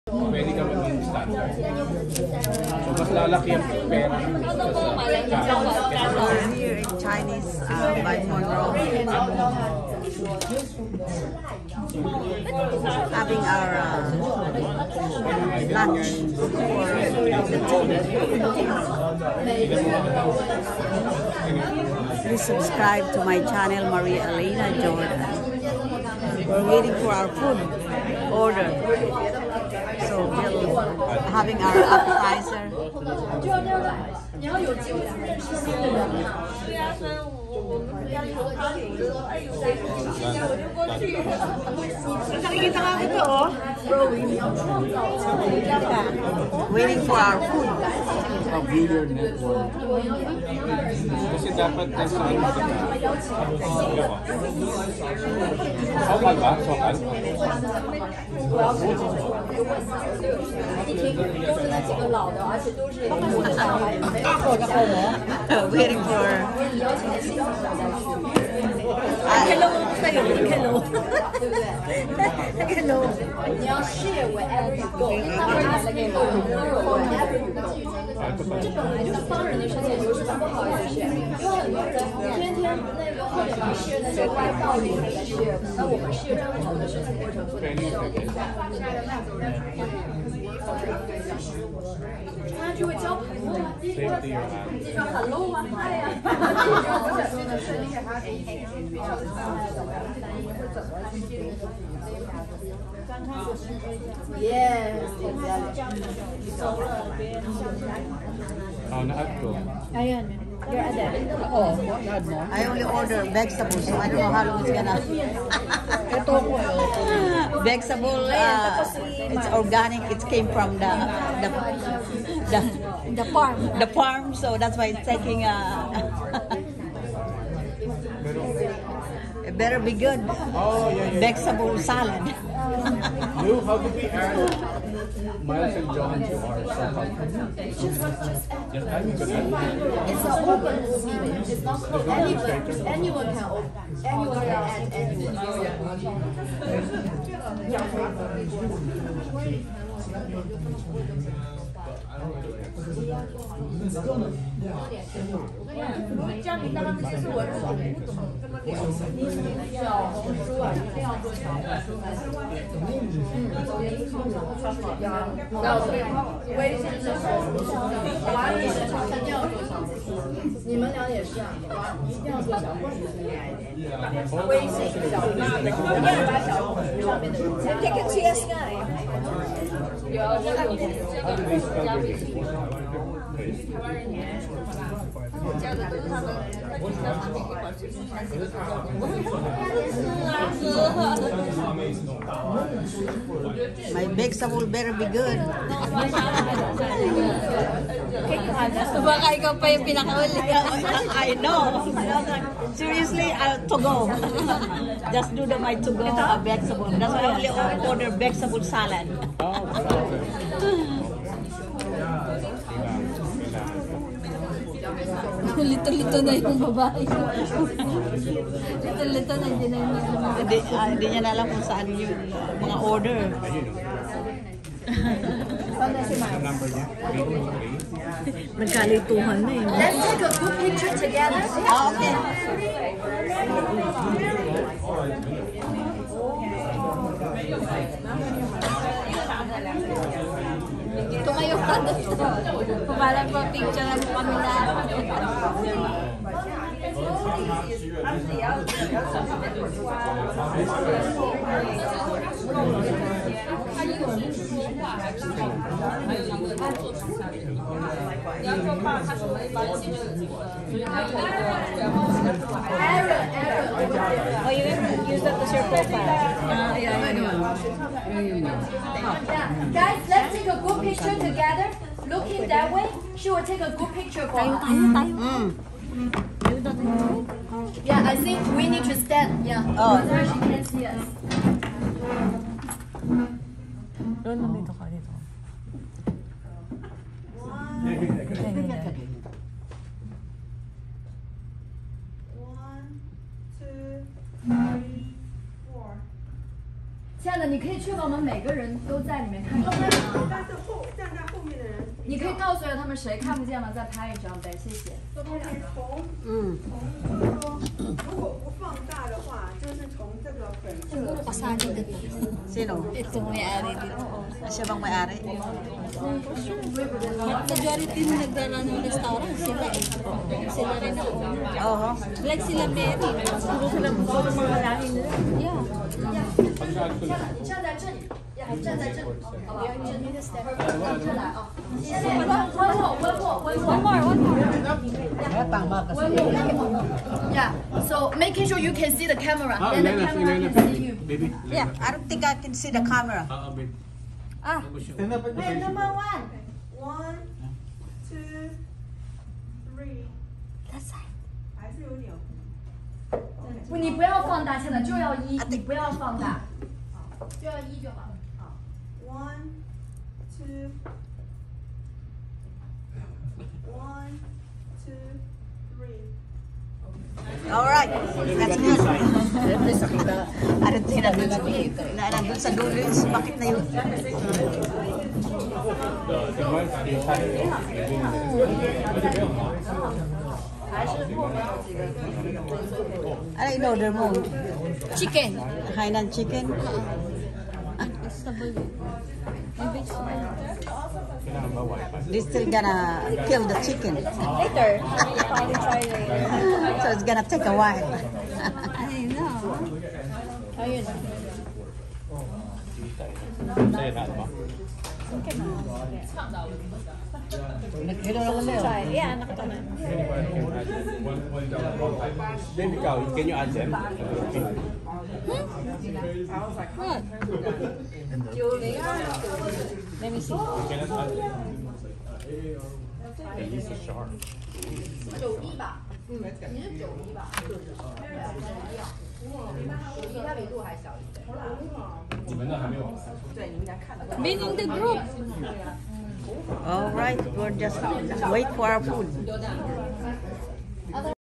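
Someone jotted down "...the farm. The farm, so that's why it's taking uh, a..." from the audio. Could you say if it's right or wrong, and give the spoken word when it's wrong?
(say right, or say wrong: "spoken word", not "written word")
right.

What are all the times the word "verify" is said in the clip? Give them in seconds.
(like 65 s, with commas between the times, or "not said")
not said.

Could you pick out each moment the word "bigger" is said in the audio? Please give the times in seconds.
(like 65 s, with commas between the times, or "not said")
48 s.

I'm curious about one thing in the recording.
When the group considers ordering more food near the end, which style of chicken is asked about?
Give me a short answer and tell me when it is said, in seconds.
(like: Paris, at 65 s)
Hainan chicken, at 385 s.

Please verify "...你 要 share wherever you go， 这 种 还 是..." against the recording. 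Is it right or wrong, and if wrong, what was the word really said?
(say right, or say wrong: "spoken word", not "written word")
right.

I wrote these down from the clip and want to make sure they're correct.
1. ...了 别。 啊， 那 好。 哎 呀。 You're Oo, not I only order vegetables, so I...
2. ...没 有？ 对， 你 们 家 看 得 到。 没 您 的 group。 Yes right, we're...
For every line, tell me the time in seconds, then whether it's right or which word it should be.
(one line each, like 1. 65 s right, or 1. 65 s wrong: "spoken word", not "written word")
1. 106 s right
2. 432 s wrong: "All", not "Yes".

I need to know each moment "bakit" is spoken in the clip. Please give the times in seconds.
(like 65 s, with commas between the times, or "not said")
373 s.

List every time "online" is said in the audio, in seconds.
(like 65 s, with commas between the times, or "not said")
not said.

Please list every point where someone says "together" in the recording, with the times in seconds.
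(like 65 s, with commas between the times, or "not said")
230 s, 271 s.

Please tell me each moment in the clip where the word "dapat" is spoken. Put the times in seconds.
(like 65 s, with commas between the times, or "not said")
51 s.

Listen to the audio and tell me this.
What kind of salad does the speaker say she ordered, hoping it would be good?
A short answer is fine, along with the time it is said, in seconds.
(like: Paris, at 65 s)
vegetable salad, at 131 s.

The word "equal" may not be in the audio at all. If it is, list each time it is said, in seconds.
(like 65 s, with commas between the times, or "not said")
not said.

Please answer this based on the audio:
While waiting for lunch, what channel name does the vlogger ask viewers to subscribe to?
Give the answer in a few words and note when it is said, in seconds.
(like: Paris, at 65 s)
Maria Elena Jordan, at 23 s.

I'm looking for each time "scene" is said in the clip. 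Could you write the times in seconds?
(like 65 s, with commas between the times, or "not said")
not said.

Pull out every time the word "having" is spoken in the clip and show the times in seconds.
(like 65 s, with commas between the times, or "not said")
7 s, 31 s.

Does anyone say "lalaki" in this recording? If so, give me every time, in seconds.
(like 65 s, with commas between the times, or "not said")
3 s.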